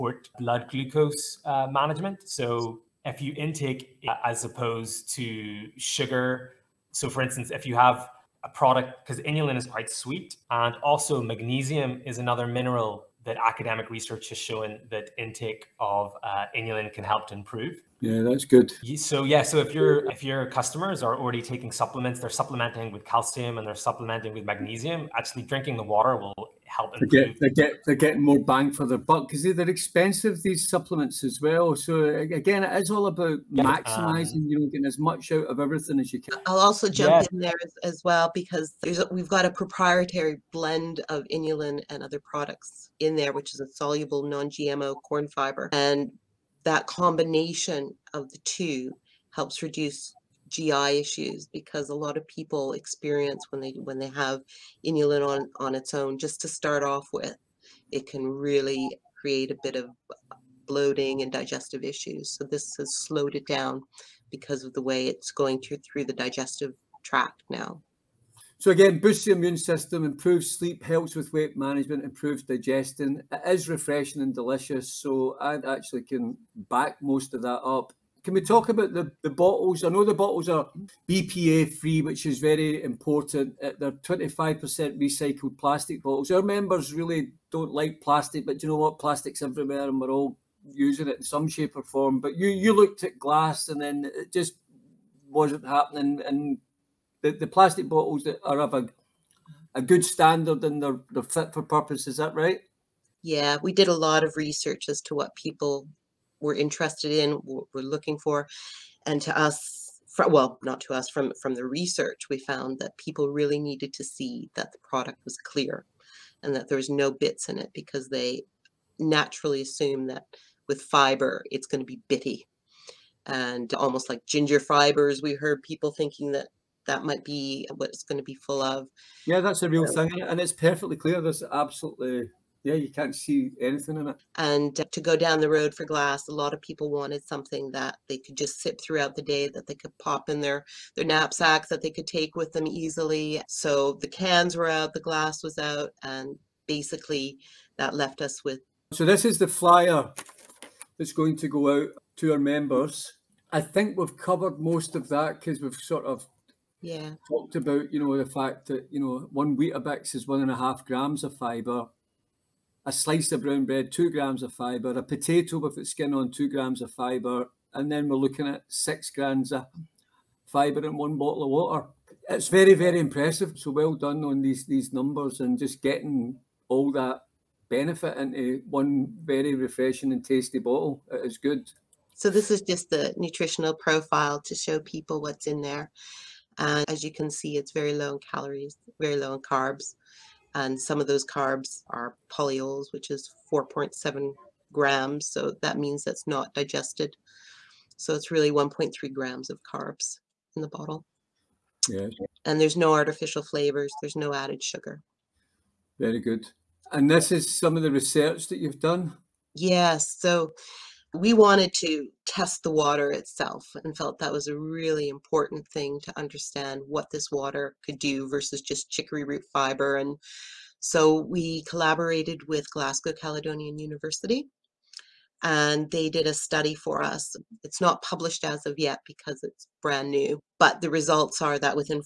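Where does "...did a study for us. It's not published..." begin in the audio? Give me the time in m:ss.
3:46.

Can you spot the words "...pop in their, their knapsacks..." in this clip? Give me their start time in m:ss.
2:19.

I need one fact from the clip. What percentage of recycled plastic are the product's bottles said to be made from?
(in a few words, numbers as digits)
25%.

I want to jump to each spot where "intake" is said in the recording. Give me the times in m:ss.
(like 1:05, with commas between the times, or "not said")
0:03, 0:15.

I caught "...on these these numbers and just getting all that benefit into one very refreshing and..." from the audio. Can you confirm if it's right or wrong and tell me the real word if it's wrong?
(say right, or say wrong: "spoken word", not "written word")
right.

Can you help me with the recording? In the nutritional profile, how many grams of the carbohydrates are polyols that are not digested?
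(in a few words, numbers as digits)
4.7 grams.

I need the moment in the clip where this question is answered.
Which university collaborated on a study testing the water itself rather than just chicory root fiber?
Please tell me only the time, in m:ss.
3:42.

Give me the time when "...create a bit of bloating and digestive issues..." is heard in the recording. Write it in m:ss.
0:59.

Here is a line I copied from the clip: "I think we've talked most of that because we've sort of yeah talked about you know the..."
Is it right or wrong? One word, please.
wrong.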